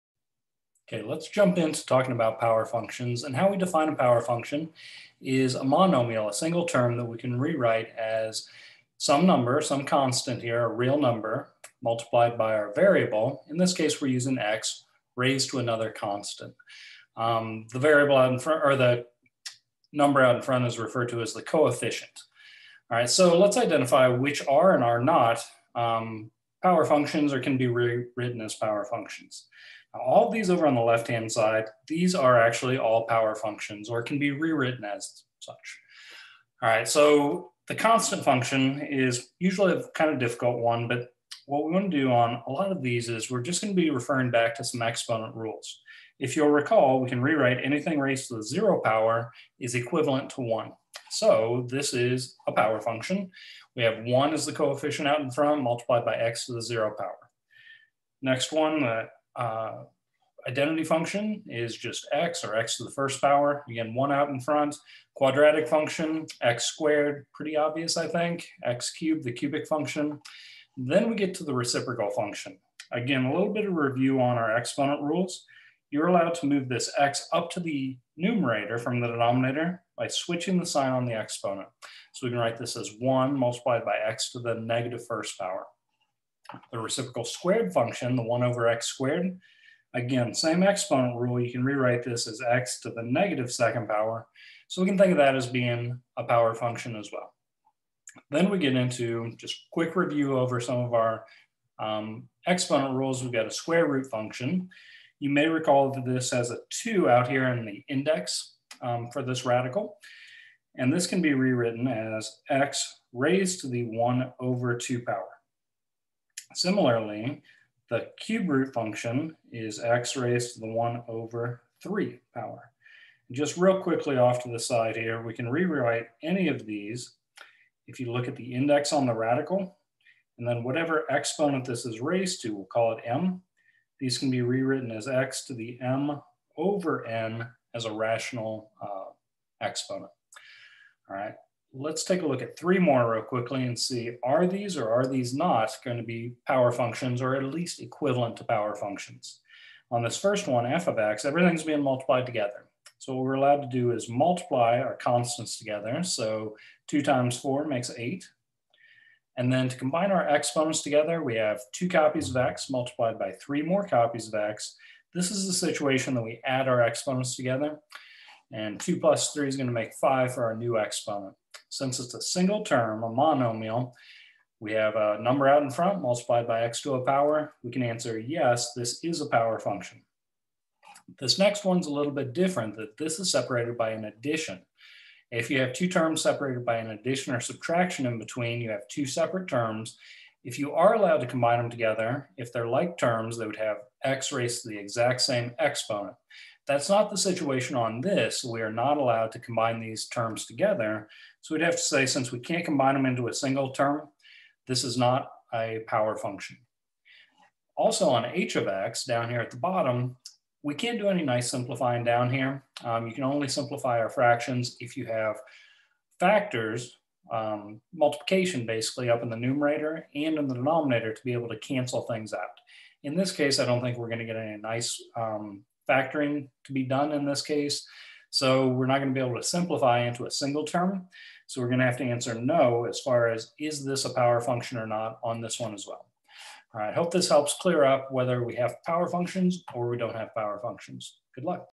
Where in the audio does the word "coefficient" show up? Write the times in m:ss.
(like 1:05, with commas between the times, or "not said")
0:21, 0:54.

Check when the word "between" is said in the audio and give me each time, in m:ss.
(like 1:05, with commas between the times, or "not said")
3:08.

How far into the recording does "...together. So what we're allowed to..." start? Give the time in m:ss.
2:32.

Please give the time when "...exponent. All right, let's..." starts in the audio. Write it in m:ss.
2:19.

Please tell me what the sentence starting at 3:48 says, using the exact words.
So we're not going to be able to simplify into a single term.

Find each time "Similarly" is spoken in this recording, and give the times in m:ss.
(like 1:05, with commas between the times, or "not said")
1:56.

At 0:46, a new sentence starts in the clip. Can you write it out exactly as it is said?
If you'll recall, we can rewrite anything raised to the zero power is equivalent to one.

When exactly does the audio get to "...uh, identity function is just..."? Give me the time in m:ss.
0:59.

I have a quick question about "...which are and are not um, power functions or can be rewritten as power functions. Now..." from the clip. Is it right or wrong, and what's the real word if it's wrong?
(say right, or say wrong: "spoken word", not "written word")
right.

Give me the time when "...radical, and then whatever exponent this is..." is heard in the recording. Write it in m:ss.
2:09.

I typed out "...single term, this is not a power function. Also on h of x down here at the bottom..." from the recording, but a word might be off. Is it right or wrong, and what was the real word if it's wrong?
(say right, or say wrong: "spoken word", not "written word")
right.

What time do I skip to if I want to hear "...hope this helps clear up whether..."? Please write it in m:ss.
3:56.